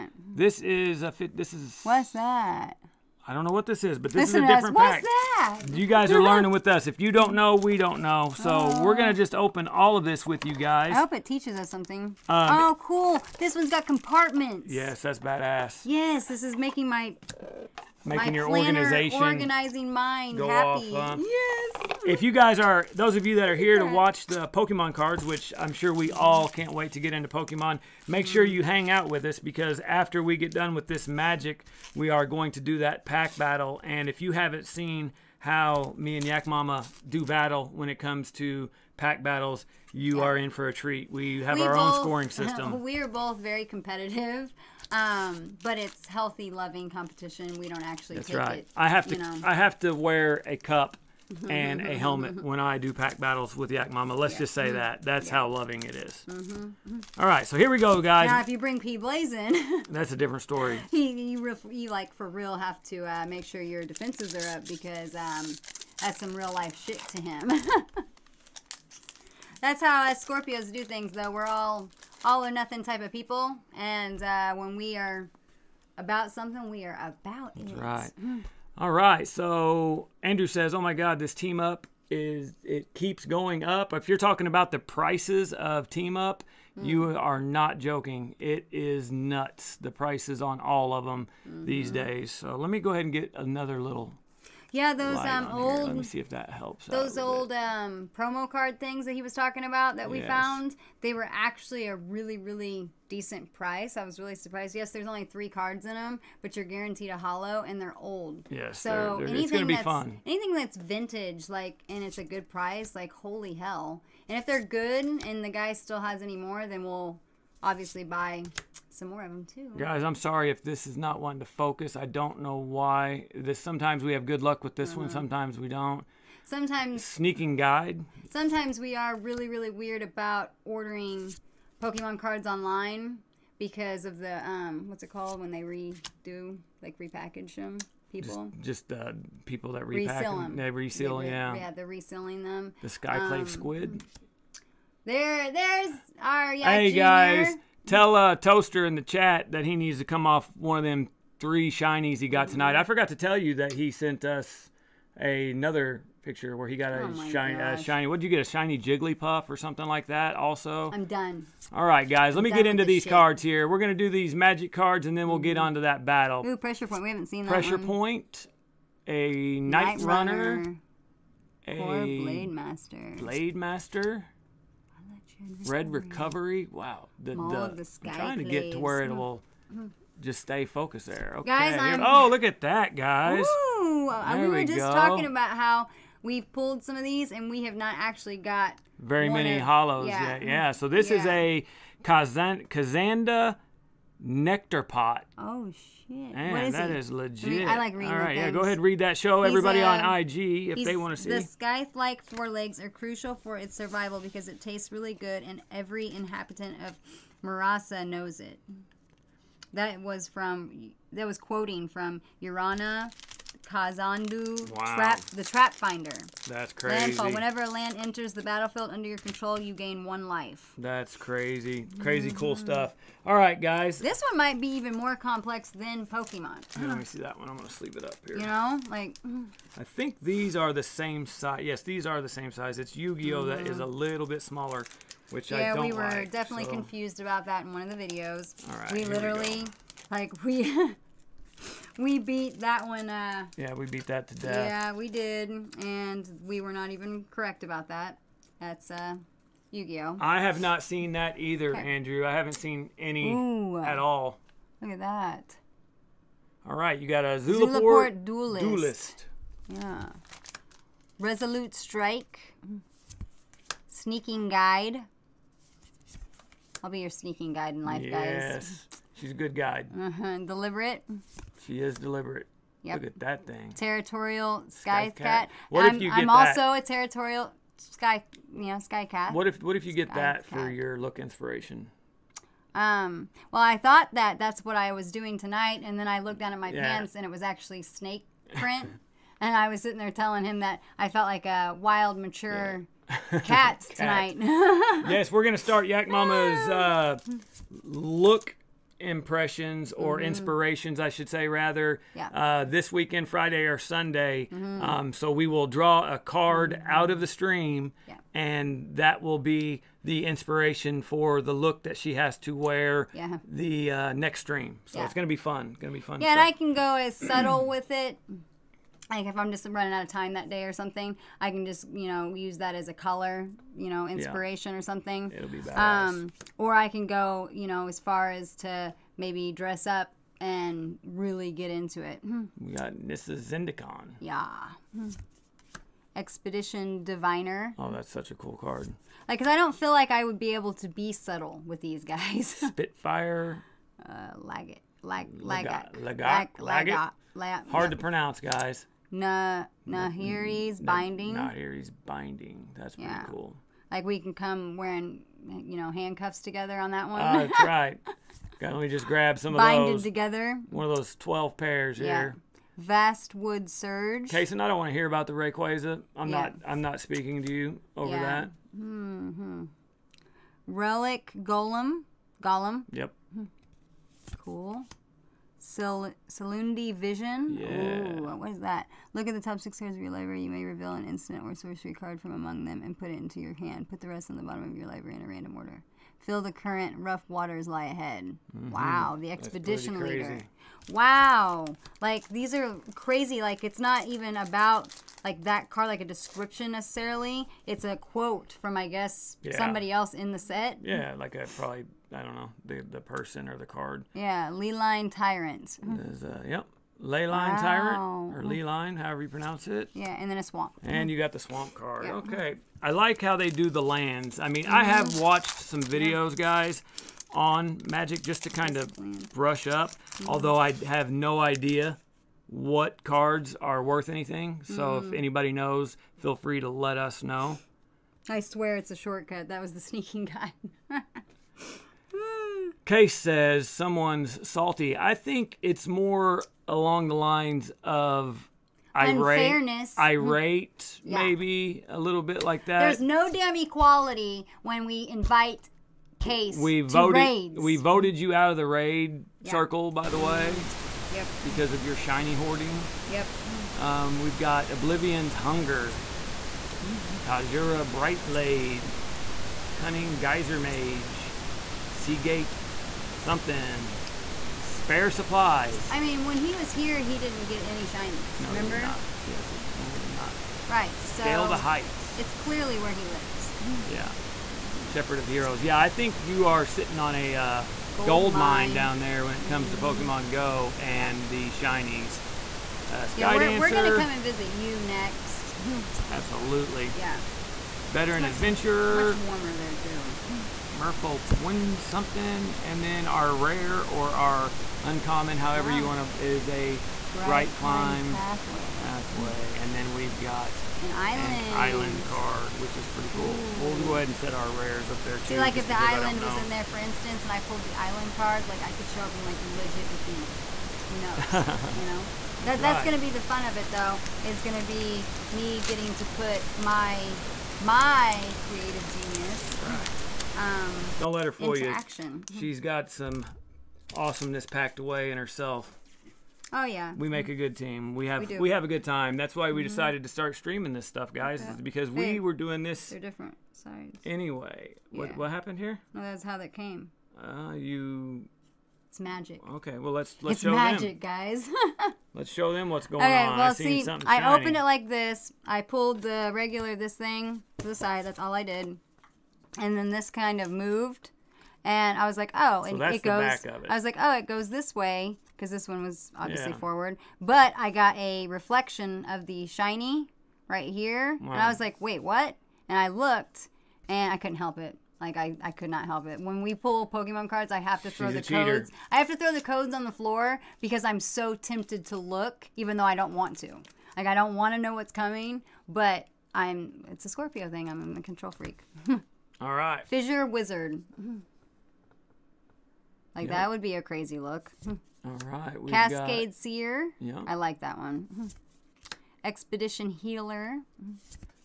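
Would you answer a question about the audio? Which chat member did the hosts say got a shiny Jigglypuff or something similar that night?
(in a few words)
Toaster.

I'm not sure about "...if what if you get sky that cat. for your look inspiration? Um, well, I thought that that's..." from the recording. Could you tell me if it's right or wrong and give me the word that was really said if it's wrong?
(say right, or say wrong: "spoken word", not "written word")
right.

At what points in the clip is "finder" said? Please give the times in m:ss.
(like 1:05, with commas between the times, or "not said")
3:35.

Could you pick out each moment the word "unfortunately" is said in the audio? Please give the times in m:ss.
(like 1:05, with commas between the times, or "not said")
not said.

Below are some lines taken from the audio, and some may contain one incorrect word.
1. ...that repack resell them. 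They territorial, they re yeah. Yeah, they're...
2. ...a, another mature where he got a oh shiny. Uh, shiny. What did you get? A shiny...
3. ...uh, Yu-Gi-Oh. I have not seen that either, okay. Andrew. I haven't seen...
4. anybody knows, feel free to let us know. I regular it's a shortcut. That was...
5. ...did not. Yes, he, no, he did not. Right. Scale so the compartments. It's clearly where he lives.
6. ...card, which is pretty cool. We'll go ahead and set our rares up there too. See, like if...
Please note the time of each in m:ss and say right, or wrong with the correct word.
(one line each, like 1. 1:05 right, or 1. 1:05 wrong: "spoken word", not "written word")
1. 2:19 wrong: "reseal", not "territorial"
2. 2:35 wrong: "picture", not "mature"
3. 4:08 right
4. 7:05 wrong: "swear", not "regular"
5. 7:48 wrong: "heights", not "compartments"
6. 8:22 right.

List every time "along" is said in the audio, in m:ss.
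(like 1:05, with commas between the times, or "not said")
7:16.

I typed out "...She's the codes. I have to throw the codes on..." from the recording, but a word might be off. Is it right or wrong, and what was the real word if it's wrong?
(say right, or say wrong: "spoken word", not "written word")
right.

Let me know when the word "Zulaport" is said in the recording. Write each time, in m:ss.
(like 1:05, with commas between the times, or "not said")
4:17.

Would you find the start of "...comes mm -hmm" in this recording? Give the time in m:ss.
7:59.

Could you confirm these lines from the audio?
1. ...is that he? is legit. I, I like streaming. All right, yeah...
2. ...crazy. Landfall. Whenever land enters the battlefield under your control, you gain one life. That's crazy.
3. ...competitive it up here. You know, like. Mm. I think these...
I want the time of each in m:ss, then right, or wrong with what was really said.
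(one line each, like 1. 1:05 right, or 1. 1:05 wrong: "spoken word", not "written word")
1. 3:16 wrong: "reading", not "streaming"
2. 3:36 right
3. 3:47 wrong: "sleeve", not "competitive".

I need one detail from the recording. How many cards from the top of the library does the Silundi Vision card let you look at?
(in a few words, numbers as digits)
6.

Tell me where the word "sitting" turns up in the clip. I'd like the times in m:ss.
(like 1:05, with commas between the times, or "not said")
4:49, 7:56.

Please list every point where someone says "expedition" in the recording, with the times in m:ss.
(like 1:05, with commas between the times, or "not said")
5:36, 6:29, 9:49.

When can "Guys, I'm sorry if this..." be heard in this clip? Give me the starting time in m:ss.
1:59.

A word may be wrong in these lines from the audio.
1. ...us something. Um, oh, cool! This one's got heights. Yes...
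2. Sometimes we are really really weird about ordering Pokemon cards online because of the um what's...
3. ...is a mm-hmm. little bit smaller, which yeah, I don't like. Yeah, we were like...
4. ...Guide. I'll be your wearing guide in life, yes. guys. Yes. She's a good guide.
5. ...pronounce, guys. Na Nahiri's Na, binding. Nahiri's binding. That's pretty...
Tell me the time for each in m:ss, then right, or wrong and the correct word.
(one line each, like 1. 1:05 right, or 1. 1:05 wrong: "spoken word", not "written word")
1. 0:11 wrong: "compartments", not "heights"
2. 2:08 right
3. 3:53 right
4. 4:24 wrong: "sneaking", not "wearing"
5. 5:47 right.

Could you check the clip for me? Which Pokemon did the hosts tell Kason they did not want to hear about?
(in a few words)
Rayquaza.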